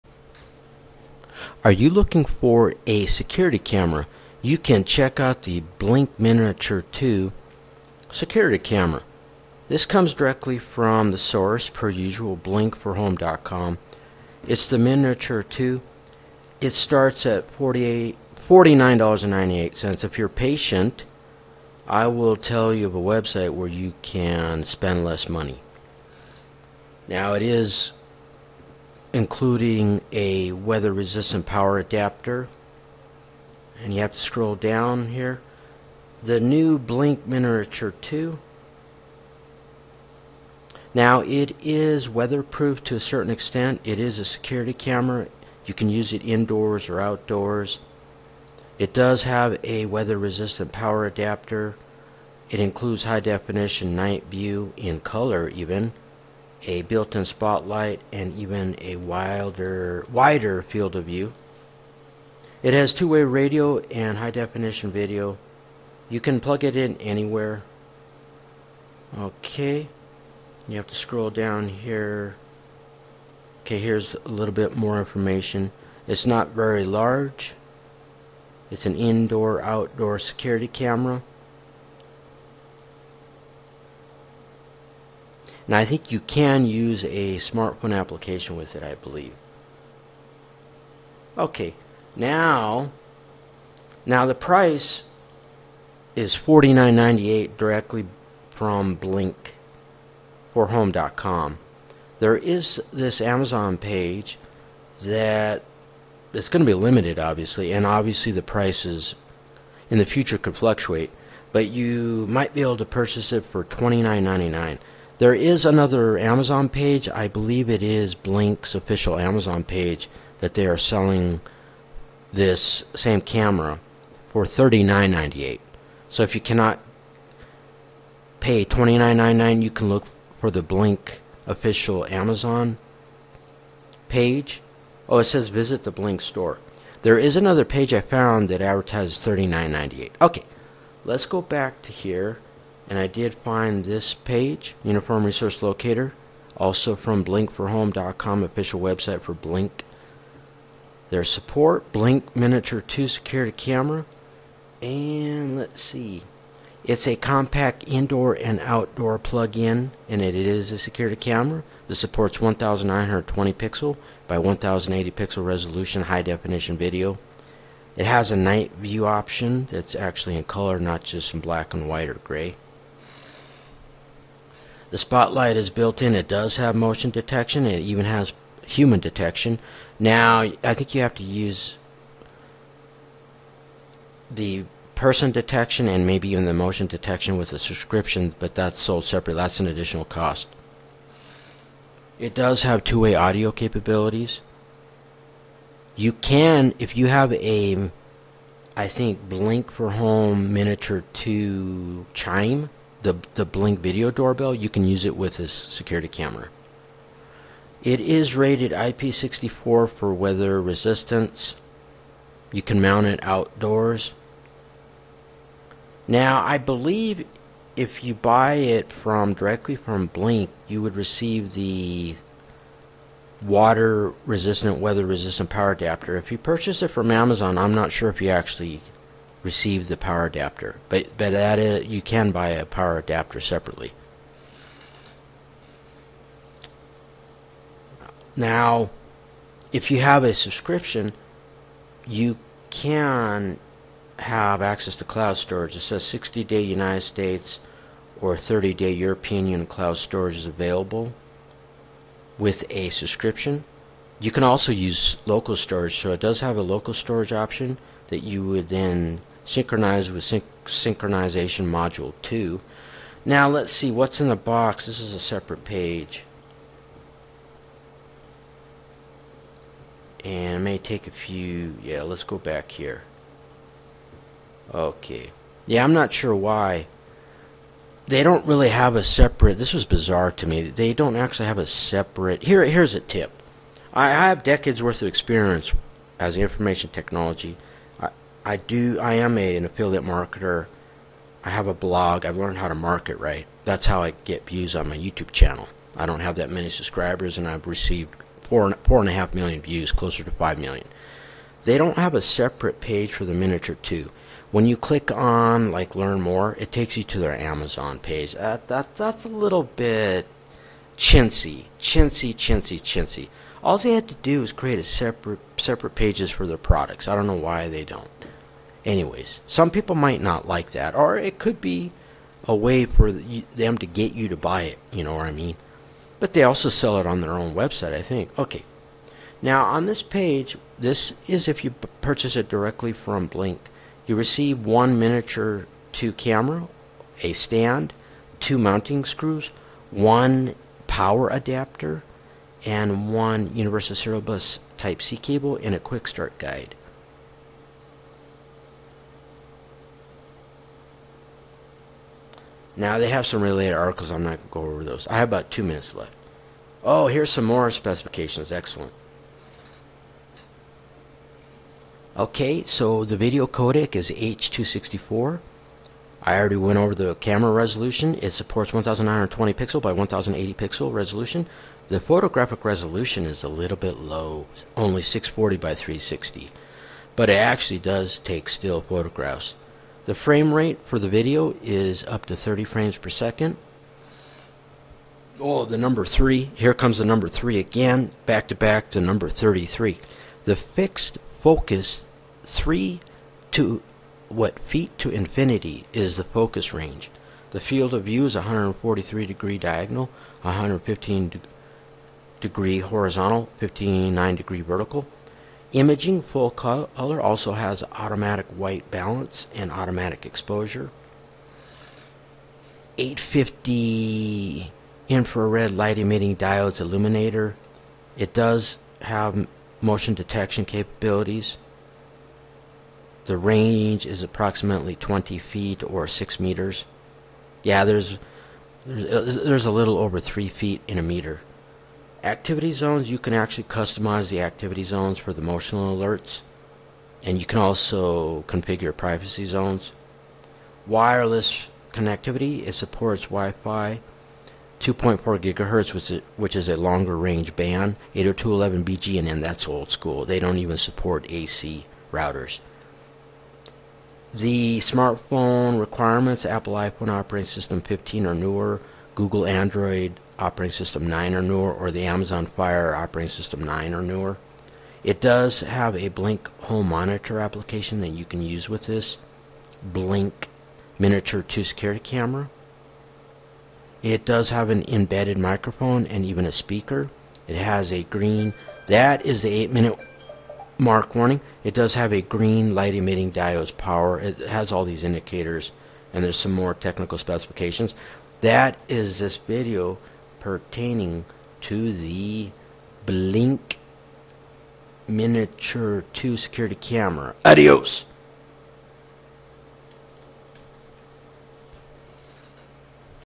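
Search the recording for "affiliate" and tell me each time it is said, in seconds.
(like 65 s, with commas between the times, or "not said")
289 s.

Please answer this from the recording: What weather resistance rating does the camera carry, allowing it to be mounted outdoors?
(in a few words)
IP64.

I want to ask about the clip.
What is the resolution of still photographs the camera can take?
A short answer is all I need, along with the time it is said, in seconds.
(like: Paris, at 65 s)
640 by 360, at 375 s.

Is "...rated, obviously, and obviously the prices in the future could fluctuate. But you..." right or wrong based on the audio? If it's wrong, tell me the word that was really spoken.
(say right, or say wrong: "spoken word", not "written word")
wrong: "limited", not "rated".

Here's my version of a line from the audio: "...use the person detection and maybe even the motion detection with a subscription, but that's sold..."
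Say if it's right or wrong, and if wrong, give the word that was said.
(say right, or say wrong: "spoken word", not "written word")
right.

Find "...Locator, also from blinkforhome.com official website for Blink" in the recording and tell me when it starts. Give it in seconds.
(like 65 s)
145 s.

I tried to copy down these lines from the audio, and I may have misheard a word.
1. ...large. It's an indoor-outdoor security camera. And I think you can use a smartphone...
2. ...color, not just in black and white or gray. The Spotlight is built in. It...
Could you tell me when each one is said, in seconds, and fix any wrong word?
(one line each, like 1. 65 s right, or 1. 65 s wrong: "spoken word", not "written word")
1. 76 s right
2. 170 s right.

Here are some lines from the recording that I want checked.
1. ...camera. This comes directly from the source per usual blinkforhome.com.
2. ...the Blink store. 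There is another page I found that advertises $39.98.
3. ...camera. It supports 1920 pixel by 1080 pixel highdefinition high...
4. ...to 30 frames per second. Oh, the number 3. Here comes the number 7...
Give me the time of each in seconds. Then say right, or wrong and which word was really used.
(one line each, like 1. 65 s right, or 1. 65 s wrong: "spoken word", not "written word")
1. 8 s right
2. 135 s right
3. 161 s wrong: "resolution", not "highdefinition"
4. 382 s wrong: "3", not "7".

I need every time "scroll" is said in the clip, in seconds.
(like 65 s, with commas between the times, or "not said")
34 s, 70 s.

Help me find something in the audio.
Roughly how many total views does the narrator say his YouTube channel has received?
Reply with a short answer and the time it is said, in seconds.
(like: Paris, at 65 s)
4.5 million, at 298 s.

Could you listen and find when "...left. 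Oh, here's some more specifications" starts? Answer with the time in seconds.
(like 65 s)
355 s.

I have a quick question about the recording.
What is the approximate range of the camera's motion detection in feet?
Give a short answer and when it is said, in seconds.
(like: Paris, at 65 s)
20 feet, at 424 s.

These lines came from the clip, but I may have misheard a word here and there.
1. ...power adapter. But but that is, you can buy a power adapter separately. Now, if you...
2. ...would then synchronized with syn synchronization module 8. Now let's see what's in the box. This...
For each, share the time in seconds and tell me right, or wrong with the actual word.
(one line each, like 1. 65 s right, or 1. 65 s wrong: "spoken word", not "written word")
1. 229 s right
2. 258 s wrong: "2", not "8".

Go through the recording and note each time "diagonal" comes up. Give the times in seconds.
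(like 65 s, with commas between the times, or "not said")
399 s.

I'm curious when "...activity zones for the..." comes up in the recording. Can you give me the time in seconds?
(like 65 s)
434 s.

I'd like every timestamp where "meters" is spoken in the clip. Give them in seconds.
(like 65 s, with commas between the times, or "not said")
426 s, 431 s.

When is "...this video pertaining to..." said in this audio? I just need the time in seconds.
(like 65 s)
489 s.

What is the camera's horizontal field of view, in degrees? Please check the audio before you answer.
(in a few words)
115.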